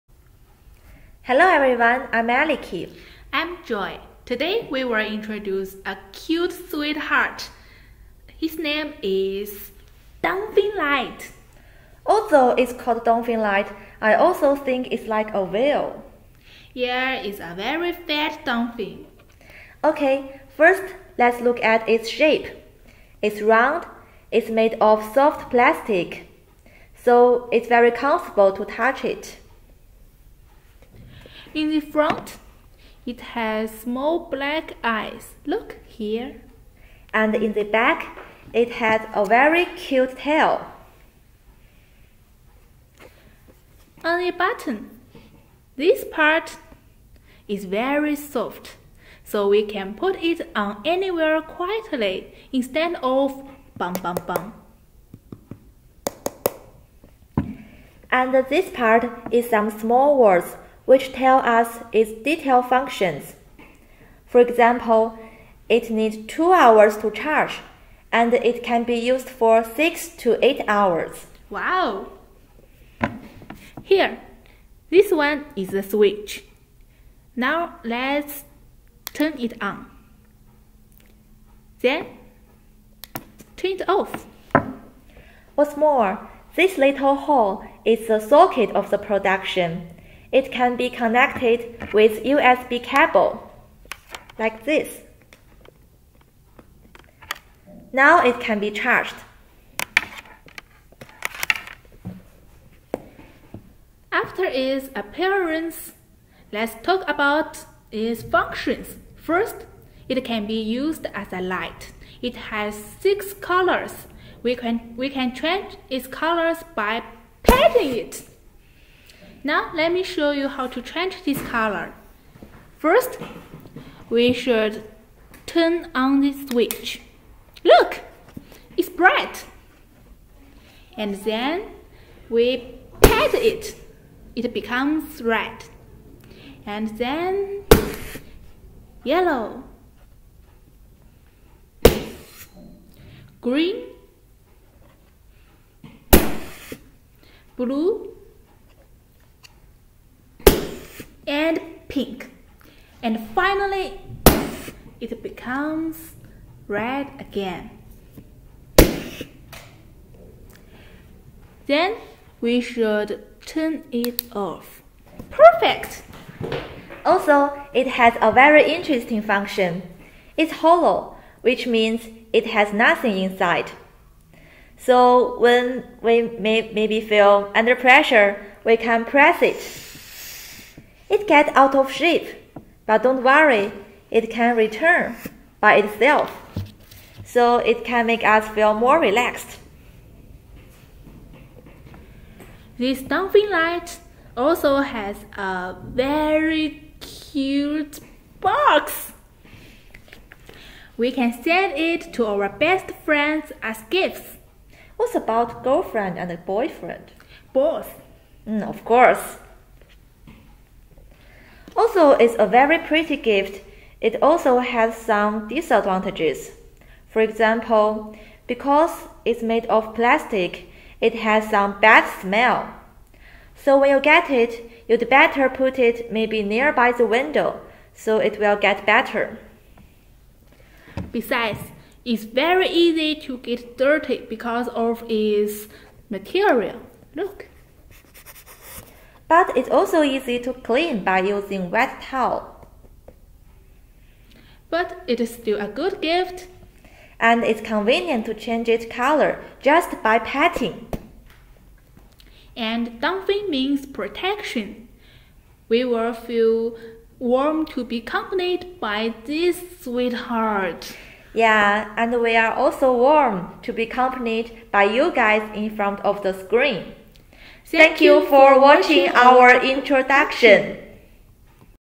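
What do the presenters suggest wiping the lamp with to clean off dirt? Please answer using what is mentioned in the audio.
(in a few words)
Wet towel.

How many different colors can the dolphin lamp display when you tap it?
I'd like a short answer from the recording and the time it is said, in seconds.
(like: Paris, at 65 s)
6, at 113 s.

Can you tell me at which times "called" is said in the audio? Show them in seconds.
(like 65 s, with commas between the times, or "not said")
12 s.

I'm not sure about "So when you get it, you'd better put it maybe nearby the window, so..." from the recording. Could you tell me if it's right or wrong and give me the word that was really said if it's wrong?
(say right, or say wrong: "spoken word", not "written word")
right.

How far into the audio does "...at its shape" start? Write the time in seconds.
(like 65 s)
21 s.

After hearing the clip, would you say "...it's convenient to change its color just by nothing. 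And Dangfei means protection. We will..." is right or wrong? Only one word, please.
wrong.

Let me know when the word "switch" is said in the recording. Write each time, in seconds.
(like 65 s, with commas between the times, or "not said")
75 s, 126 s.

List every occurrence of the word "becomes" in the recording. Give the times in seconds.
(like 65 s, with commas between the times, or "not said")
134 s, 155 s.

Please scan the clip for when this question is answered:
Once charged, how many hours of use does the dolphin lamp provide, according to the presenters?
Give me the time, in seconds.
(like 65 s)
69 s.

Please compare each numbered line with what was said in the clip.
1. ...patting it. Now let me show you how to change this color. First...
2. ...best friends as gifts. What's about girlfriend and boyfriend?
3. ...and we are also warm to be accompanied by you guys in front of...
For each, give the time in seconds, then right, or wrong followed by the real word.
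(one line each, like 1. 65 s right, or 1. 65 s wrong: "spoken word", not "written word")
1. 117 s right
2. 202 s right
3. 261 s right.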